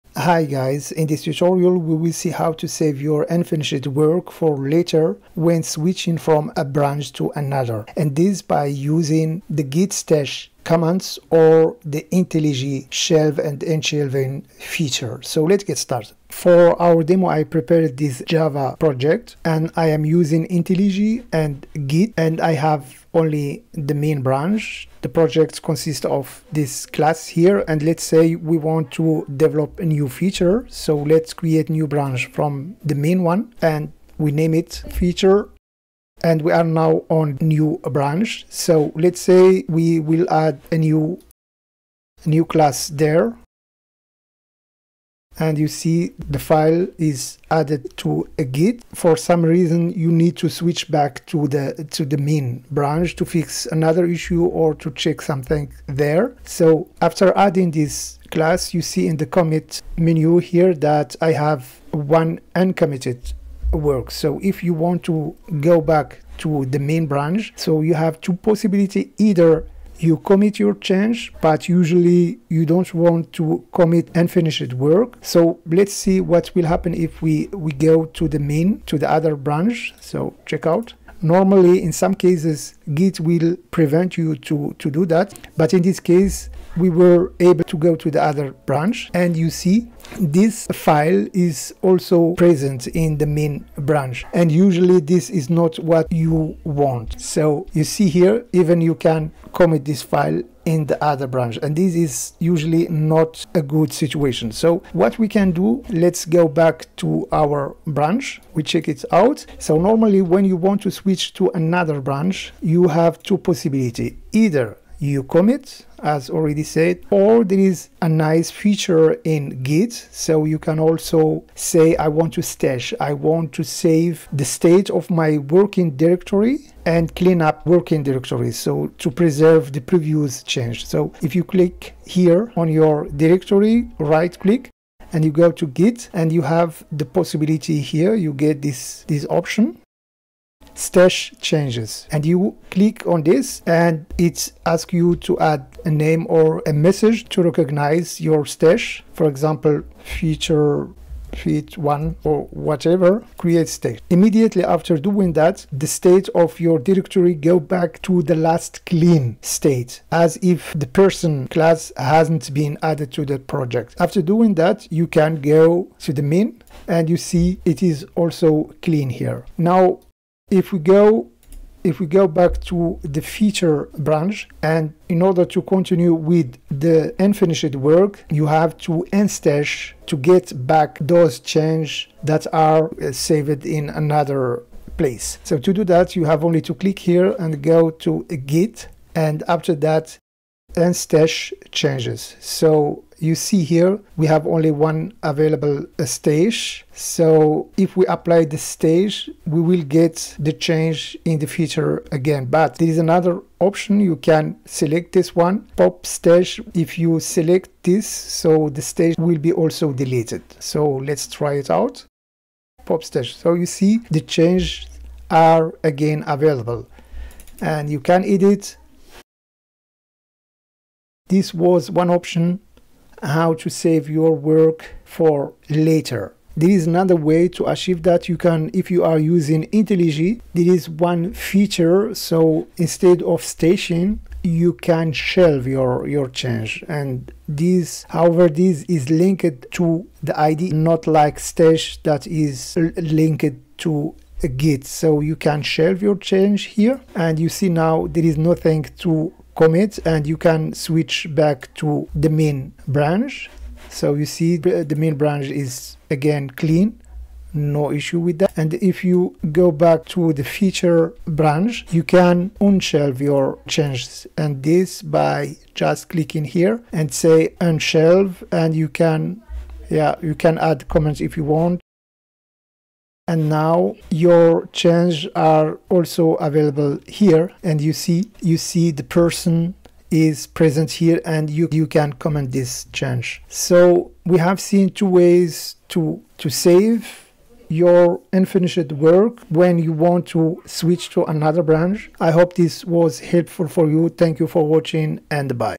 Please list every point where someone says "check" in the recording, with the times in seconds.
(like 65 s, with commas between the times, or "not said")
54 s, 80 s, 108 s.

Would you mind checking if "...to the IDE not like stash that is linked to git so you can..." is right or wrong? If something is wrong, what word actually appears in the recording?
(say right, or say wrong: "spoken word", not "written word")
right.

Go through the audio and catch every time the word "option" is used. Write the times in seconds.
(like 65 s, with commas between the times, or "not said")
139 s, 203 s, 222 s.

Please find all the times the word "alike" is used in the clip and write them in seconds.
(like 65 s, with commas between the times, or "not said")
not said.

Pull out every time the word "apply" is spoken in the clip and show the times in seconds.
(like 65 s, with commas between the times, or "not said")
198 s.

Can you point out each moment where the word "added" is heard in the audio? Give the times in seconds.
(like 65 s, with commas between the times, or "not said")
47 s, 162 s.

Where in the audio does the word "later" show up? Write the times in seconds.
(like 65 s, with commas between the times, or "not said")
4 s, 225 s.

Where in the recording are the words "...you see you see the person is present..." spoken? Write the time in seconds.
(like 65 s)
277 s.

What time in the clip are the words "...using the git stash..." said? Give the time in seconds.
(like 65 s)
8 s.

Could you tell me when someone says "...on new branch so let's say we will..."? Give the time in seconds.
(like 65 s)
37 s.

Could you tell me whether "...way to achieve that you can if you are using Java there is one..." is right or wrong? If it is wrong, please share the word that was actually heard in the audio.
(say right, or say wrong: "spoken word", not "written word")
wrong: "IntelliJ", not "Java".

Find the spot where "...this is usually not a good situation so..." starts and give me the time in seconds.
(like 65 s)
101 s.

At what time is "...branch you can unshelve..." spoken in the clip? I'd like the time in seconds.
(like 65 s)
261 s.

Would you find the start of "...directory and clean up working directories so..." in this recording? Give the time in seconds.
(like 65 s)
125 s.